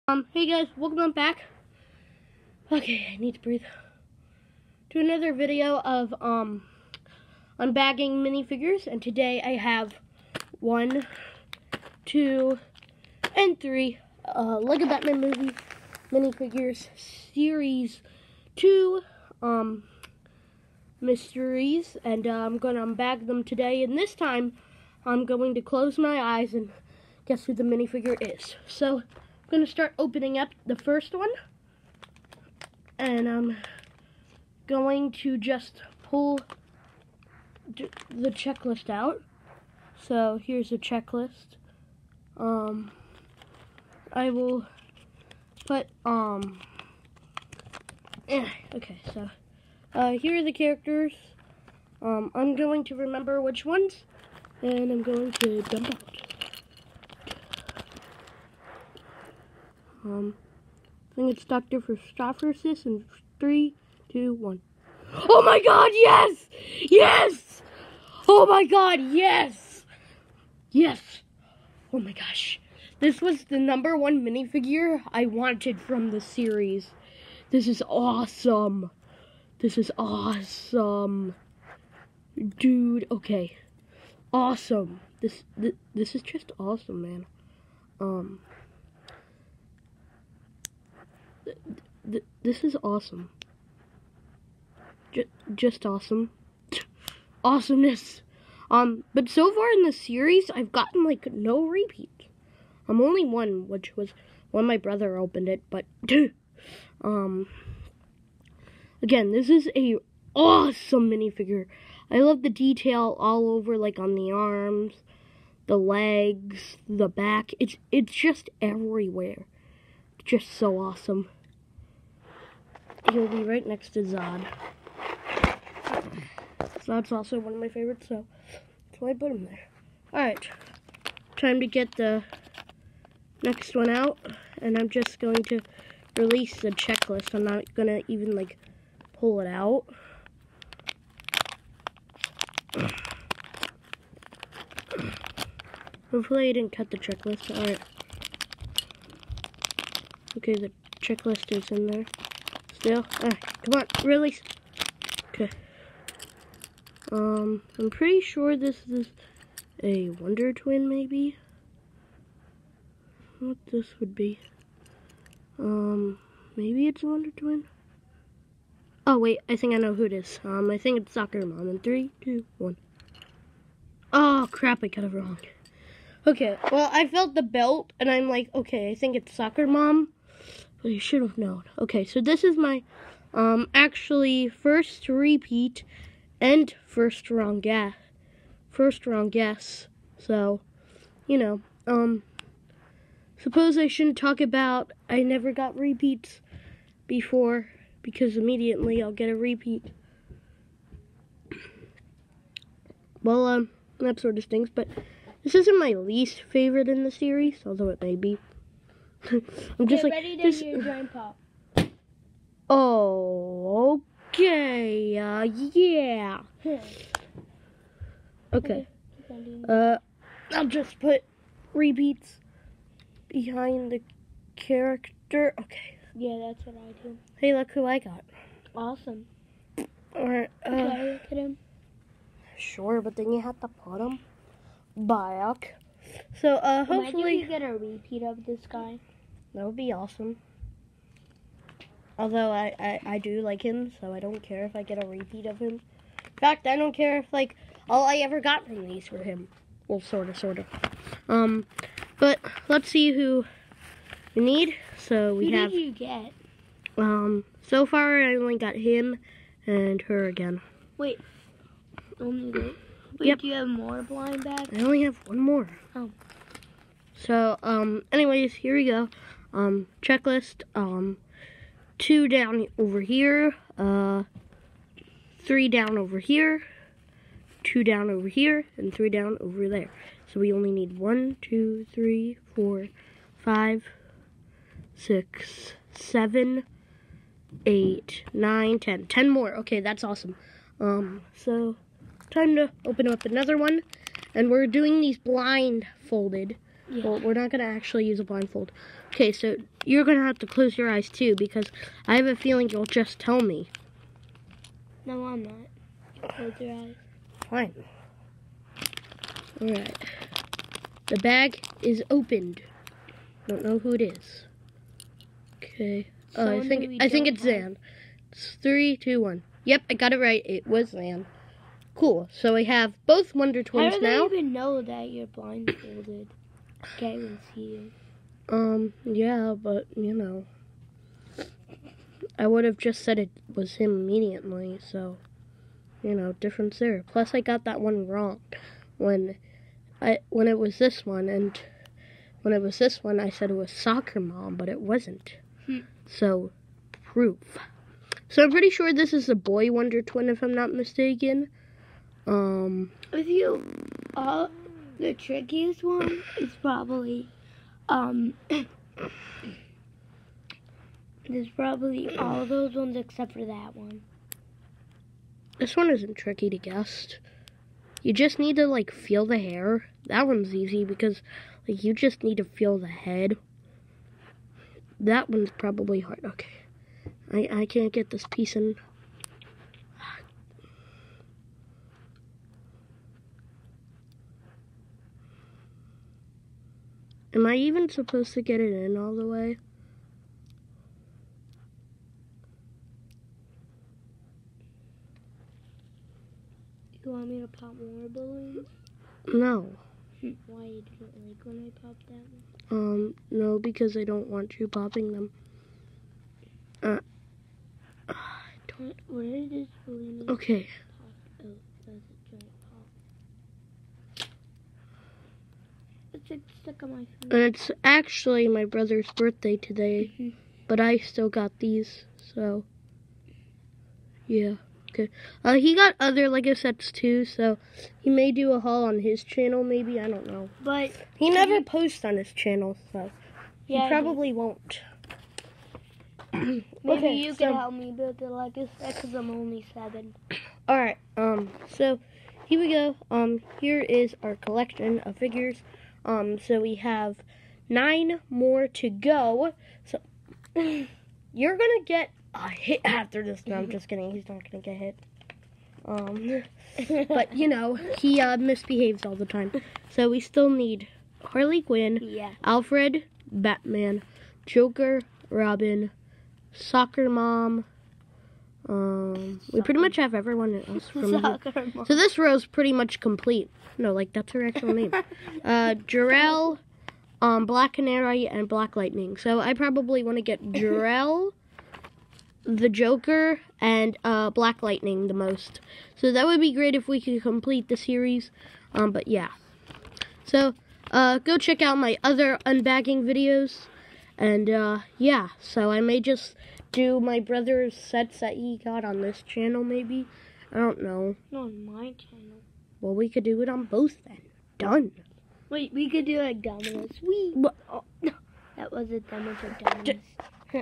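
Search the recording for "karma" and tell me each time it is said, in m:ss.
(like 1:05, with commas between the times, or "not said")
not said.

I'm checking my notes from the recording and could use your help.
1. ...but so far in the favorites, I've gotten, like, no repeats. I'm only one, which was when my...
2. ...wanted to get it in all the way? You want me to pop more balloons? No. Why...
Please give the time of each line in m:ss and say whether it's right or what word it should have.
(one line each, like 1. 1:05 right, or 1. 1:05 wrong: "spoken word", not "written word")
1. 1:39 wrong: "series", not "favorites"
2. 6:27 wrong: "supposed", not "wanted".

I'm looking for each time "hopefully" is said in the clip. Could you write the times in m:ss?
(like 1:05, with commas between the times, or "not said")
2:26, 3:56.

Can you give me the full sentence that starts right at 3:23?
Well, um, that sort of stinks, but this isn't my least favorite in the series, although it may be.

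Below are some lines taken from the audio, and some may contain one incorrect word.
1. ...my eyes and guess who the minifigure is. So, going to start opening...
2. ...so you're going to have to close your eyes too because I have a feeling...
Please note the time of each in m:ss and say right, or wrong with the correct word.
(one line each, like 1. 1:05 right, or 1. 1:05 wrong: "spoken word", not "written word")
1. 0:25 right
2. 4:59 right.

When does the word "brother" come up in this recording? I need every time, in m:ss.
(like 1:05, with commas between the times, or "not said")
1:44, 6:58, 8:17.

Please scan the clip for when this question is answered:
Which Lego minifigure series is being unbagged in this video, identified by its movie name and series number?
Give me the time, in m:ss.
0:14.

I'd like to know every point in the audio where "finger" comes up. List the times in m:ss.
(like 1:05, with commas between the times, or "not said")
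6:57.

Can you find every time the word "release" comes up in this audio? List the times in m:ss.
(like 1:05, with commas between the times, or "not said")
2:16, 2:34.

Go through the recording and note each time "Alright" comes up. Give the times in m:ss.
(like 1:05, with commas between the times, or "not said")
2:10, 2:27, 5:09.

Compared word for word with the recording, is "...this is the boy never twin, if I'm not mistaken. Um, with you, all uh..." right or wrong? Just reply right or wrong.
wrong.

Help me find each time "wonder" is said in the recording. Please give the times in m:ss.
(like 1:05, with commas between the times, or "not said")
2:40, 2:47, 5:23, 5:49.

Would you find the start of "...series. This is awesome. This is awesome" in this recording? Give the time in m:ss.
1:16.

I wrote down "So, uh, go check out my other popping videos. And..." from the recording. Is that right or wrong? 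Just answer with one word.
wrong.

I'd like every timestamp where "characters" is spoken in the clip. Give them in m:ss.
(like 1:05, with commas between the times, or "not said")
0:50, 3:44.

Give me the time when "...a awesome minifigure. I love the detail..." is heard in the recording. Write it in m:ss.
1:49.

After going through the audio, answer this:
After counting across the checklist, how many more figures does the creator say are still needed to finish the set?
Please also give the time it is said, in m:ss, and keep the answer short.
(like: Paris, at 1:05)
10, at 4:49.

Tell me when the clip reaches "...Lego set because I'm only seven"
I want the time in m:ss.
7:18.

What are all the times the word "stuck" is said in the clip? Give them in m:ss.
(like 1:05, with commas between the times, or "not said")
6:56.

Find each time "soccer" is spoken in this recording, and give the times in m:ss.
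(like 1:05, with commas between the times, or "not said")
2:51, 2:59, 5:43, 7:46.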